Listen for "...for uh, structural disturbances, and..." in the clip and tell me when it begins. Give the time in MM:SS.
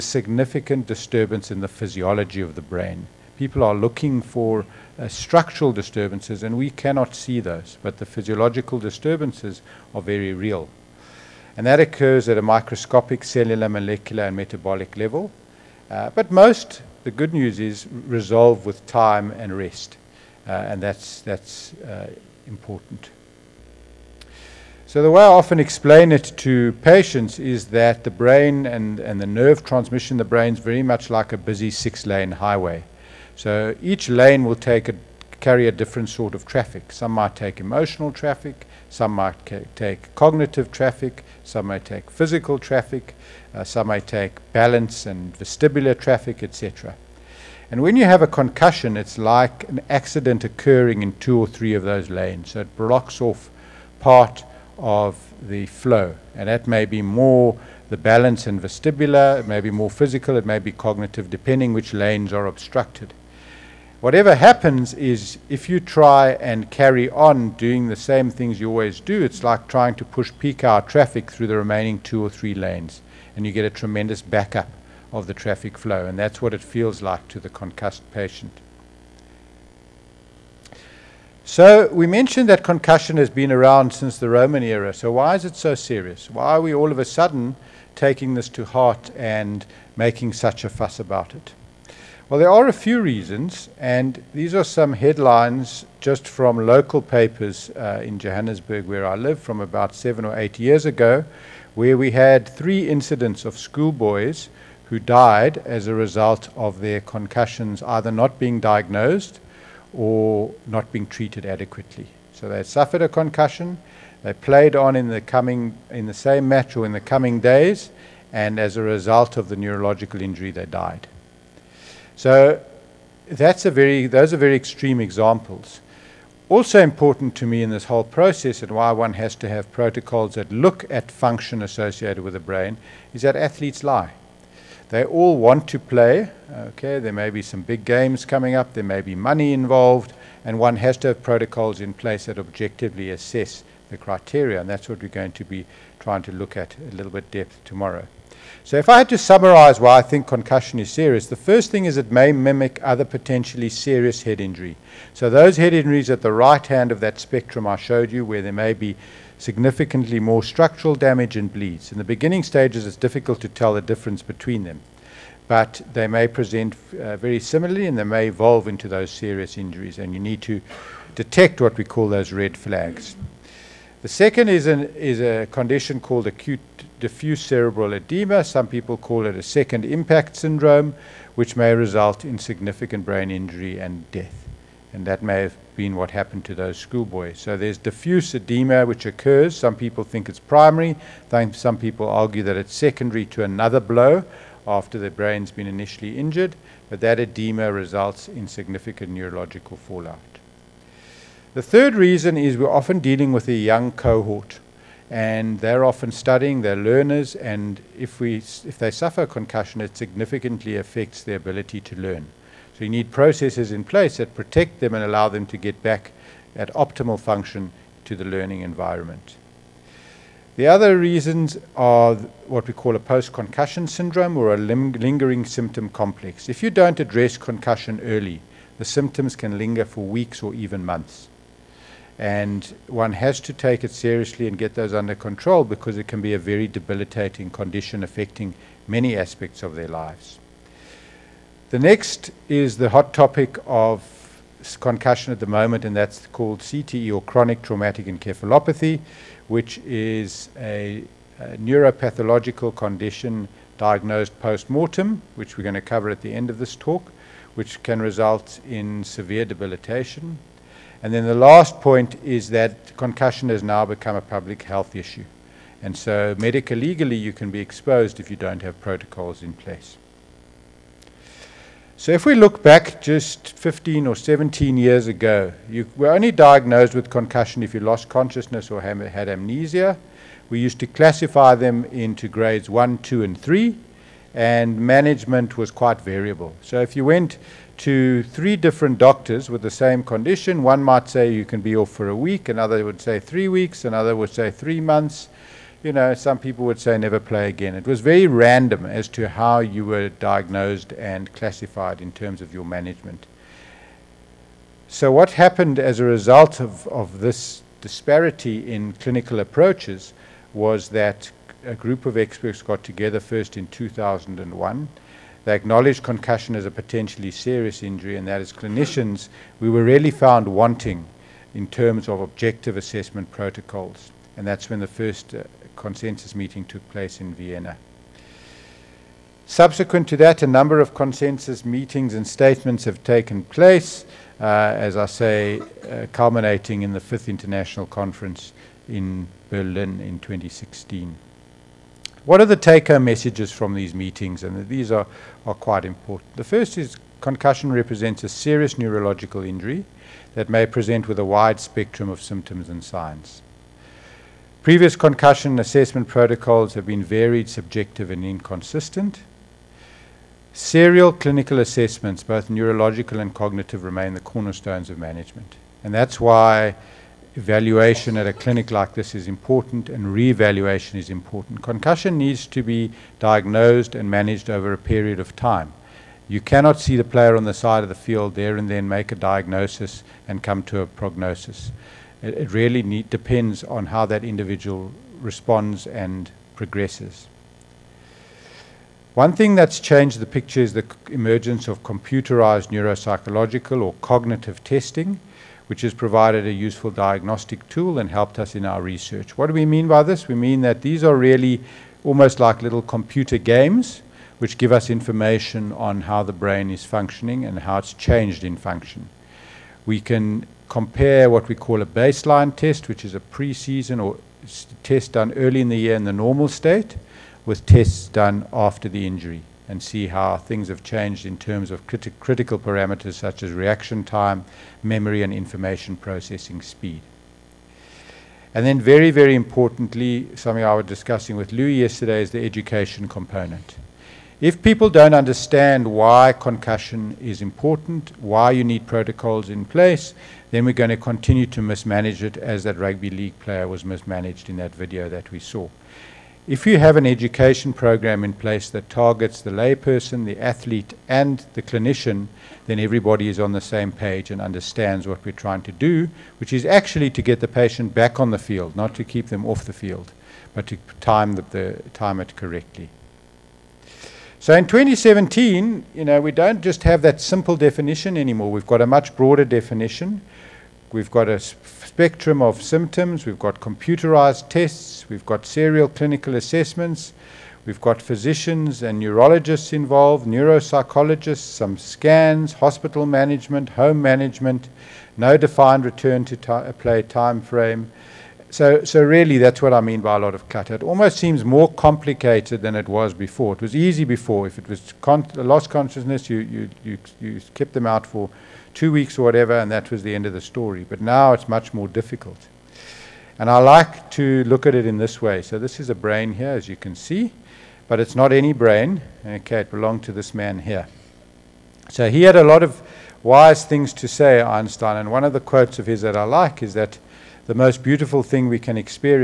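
00:04.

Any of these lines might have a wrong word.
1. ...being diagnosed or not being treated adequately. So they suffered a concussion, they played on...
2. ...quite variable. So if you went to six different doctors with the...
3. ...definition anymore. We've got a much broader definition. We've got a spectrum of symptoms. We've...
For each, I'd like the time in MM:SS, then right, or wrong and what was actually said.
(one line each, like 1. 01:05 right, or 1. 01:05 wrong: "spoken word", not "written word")
1. 01:48 right
2. 04:45 wrong: "three", not "six"
3. 07:47 right.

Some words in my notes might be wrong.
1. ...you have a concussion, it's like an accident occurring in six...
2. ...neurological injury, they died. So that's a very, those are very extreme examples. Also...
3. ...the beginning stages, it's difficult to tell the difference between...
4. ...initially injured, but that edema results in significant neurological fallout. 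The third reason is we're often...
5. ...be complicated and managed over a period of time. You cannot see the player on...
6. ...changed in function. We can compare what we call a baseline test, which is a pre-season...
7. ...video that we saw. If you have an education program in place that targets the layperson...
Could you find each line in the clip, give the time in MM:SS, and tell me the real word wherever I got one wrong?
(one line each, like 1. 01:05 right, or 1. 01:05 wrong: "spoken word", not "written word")
1. 00:47 wrong: "two", not "six"
2. 01:59 right
3. 02:41 right
4. 03:15 right
5. 06:12 wrong: "diagnosed", not "complicated"
6. 06:47 right
7. 07:24 right.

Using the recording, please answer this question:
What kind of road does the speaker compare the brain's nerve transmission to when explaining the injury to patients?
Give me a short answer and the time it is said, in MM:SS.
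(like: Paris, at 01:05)
Six-lane highway, at 00:31.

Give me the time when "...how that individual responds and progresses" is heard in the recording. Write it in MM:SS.
06:23.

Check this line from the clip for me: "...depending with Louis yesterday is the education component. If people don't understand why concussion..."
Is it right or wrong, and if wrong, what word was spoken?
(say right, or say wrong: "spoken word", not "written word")
wrong: "discussing", not "depending".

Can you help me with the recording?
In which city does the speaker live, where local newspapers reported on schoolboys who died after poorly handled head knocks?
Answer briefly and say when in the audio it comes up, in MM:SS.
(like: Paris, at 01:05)
Johannesburg, at 01:38.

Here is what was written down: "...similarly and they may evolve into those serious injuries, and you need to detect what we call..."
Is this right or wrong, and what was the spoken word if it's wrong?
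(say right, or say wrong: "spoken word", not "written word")
right.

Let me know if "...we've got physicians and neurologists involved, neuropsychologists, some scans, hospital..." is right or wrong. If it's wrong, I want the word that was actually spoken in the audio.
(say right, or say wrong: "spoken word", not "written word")
right.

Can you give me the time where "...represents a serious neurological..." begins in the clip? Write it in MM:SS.
05:47.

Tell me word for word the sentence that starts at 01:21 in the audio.
So we mentioned that concussion has been around since the Roman era.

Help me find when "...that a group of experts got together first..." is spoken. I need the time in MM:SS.
05:10.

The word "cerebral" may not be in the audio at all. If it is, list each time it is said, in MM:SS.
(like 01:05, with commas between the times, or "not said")
02:57.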